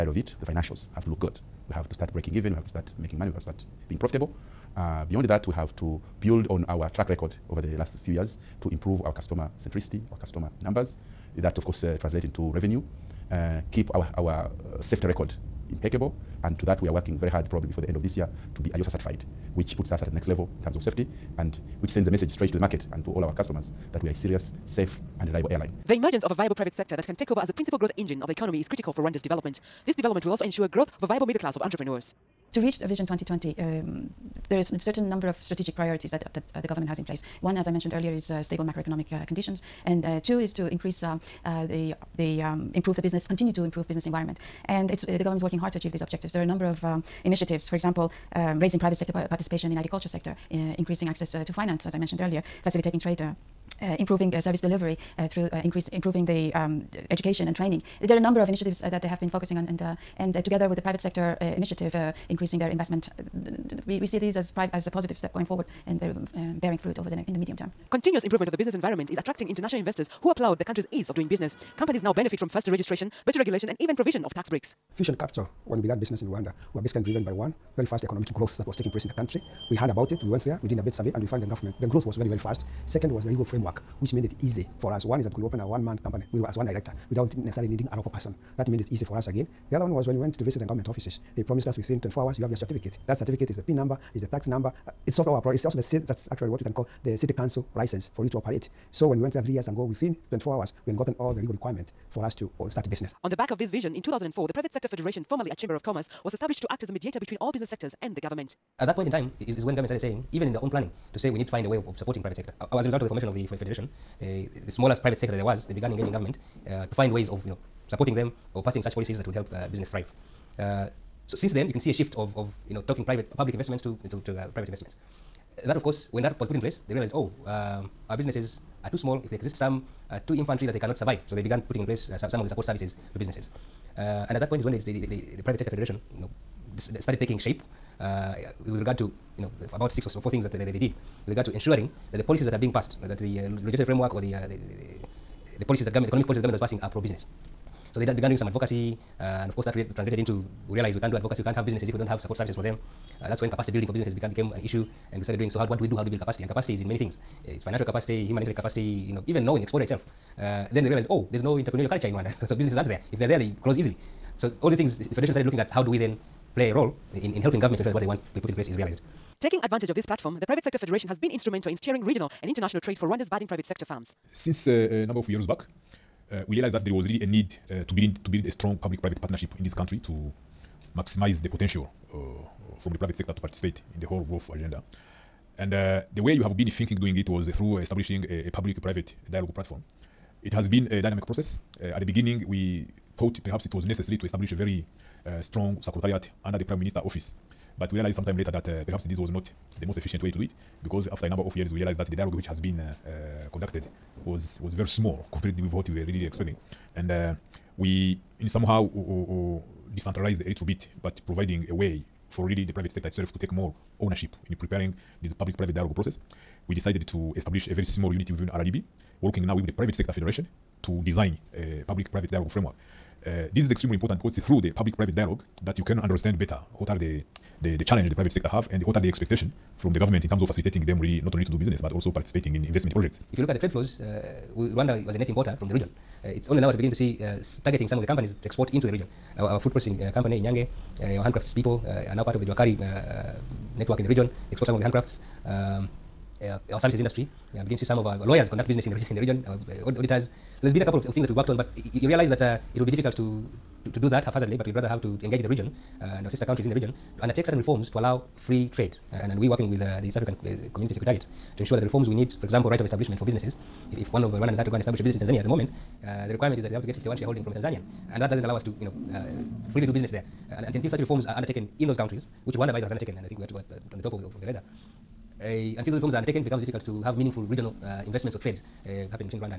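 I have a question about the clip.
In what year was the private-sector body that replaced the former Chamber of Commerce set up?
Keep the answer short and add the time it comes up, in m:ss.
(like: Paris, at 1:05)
2004, at 1:44.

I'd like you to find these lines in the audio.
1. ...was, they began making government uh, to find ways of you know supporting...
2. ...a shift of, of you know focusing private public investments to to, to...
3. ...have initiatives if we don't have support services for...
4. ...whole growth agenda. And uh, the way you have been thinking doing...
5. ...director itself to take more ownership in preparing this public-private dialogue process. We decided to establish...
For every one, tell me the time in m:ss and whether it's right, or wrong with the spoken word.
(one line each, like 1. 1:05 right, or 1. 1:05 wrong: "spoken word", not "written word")
1. 1:55 wrong: "engaging", not "making"
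2. 2:01 wrong: "talking", not "focusing"
3. 2:31 wrong: "businesses", not "initiatives"
4. 3:04 right
5. 3:32 wrong: "sector", not "director".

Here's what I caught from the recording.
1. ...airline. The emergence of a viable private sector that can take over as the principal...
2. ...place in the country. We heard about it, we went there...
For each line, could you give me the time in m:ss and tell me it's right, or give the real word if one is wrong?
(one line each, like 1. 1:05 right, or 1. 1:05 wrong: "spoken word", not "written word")
1. 0:25 right
2. 1:18 right.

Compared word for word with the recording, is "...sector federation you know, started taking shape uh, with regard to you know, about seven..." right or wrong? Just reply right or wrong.
wrong.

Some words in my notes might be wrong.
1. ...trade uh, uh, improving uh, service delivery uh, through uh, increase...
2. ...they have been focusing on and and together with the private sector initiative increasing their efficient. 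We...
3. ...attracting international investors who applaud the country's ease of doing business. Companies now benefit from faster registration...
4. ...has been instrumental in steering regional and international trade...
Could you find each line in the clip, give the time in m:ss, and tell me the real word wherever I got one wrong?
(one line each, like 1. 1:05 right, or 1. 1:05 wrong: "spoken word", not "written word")
1. 0:52 right
2. 0:59 wrong: "investment", not "efficient"
3. 1:09 right
4. 2:51 right.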